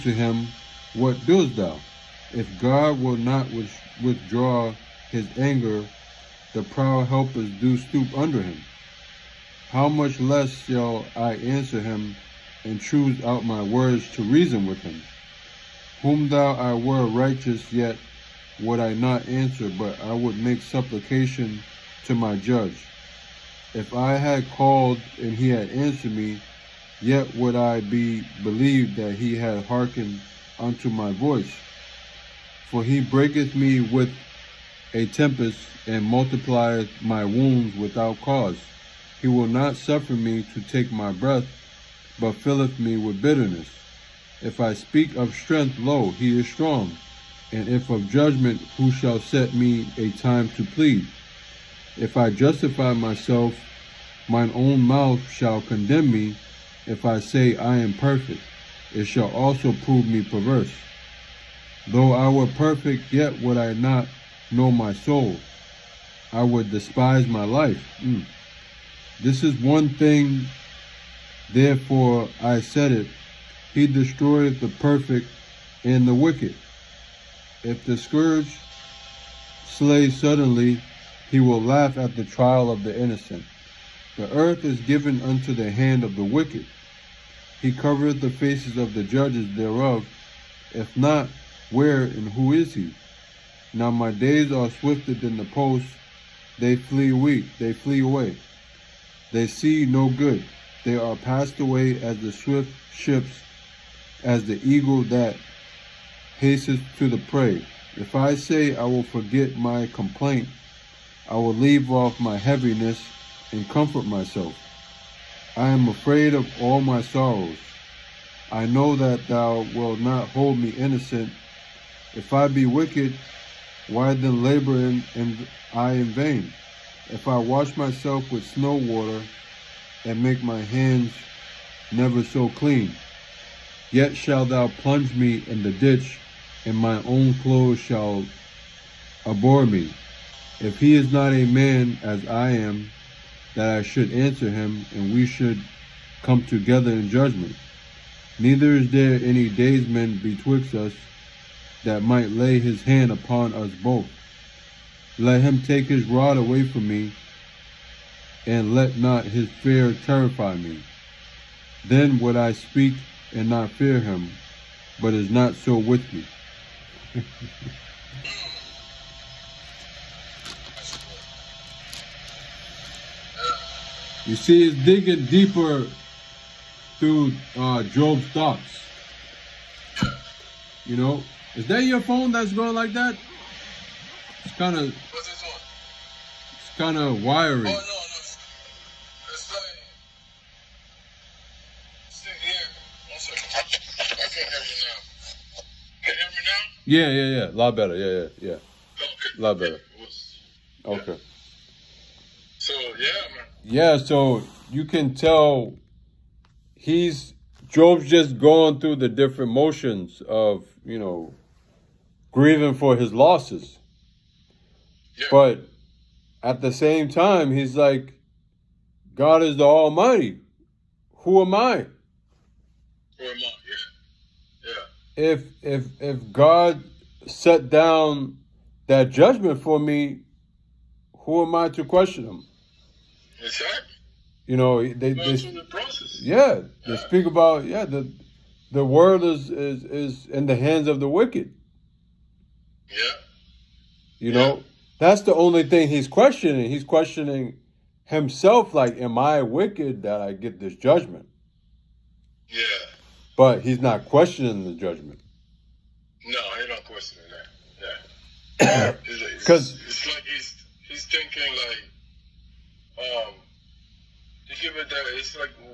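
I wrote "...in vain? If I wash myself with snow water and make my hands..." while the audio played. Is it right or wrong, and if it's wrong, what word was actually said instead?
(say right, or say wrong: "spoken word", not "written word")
right.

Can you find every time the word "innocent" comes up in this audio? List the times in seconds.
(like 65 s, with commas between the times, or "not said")
82 s, 120 s.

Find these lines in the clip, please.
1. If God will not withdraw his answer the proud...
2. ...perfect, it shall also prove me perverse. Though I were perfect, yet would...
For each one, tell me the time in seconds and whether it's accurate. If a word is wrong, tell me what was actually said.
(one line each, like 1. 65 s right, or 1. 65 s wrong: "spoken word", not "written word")
1. 2 s wrong: "anger", not "answer"
2. 57 s right.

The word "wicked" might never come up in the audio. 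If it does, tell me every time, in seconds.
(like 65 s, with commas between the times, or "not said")
76 s, 86 s, 122 s, 241 s, 249 s.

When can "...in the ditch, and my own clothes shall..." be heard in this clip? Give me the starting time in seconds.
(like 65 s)
135 s.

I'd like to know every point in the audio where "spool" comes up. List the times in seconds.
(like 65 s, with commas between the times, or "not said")
not said.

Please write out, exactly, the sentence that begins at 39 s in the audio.
He will not suffer me to take my breath, but filleth me with bitterness.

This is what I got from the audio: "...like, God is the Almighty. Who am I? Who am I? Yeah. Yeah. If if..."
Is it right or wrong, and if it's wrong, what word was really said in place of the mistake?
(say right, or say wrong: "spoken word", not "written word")
right.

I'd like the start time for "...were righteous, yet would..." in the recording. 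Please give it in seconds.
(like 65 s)
16 s.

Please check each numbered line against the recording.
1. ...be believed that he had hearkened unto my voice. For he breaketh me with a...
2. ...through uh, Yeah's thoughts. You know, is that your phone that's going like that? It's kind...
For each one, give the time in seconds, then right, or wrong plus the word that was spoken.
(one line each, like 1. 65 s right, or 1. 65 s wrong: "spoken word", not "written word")
1. 27 s right
2. 176 s wrong: "Job", not "Yeah".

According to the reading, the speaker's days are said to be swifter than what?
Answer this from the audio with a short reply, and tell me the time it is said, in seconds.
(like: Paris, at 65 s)
the post, at 95 s.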